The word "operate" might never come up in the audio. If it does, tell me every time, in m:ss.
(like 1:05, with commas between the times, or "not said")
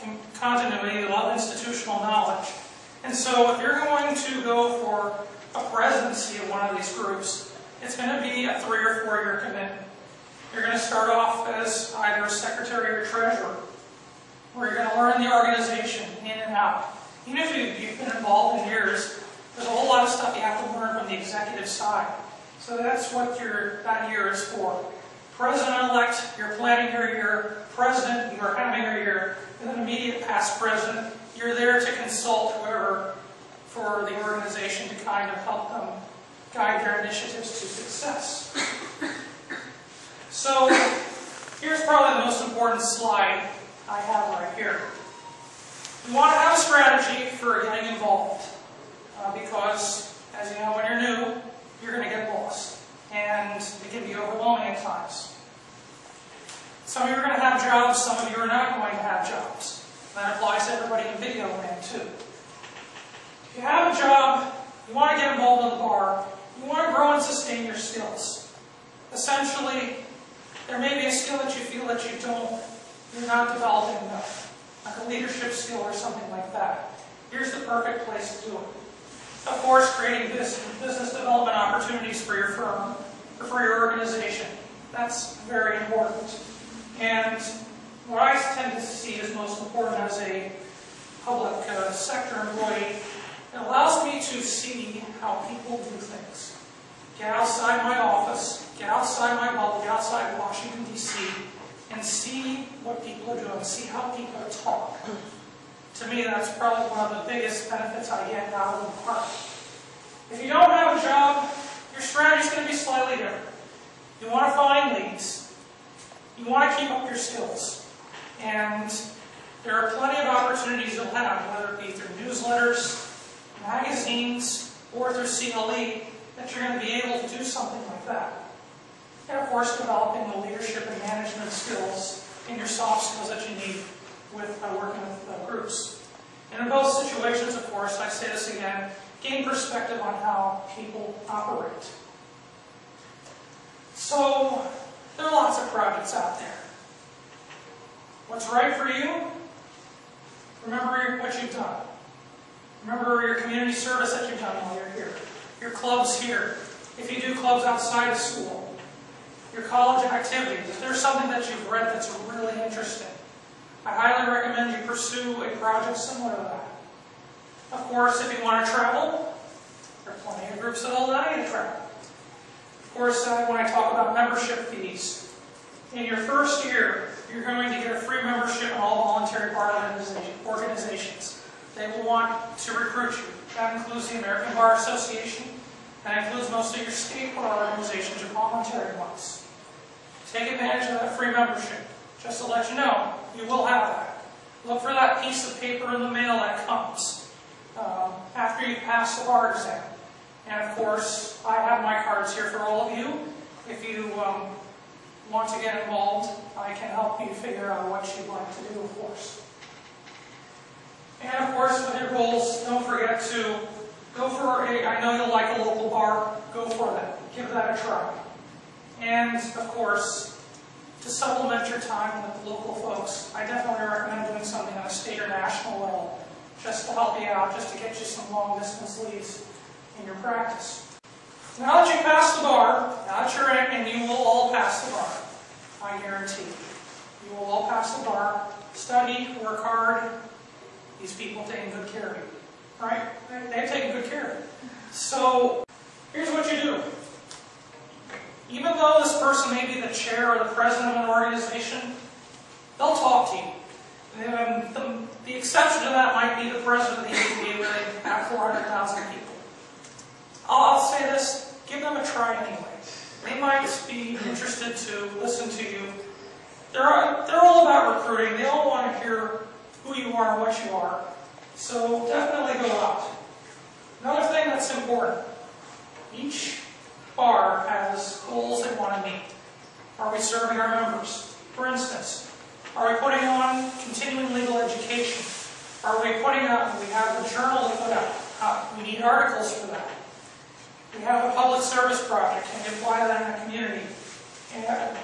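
2:21.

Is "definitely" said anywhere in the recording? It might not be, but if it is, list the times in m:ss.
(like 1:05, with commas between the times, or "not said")
3:43, 4:32.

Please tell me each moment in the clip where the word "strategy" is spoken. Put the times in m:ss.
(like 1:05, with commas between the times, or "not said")
0:46, 1:52.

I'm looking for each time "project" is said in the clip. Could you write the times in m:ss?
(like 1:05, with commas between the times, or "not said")
2:25, 2:45, 4:52.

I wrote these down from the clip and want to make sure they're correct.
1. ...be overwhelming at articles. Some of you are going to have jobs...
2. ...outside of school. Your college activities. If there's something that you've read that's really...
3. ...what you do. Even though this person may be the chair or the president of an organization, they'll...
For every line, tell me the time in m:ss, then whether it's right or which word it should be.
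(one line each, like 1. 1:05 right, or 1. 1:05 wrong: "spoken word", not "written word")
1. 0:54 wrong: "times", not "articles"
2. 2:37 right
3. 4:06 right.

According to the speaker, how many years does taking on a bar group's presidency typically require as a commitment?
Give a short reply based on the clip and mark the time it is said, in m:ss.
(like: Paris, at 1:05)
3 or 4 years, at 0:08.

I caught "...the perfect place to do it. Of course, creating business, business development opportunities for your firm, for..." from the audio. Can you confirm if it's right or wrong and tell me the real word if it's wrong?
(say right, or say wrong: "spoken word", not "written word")
right.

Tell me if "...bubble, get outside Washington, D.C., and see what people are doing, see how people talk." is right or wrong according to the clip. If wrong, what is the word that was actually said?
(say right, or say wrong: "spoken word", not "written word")
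right.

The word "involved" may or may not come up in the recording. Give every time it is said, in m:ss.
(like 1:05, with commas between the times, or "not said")
0:18, 0:47, 1:05, 3:25.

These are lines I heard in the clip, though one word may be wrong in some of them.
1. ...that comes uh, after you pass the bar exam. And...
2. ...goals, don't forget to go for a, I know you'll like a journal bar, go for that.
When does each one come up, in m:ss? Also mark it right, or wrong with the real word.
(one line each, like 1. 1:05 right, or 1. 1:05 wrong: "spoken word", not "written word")
1. 3:16 right
2. 3:32 wrong: "local", not "journal".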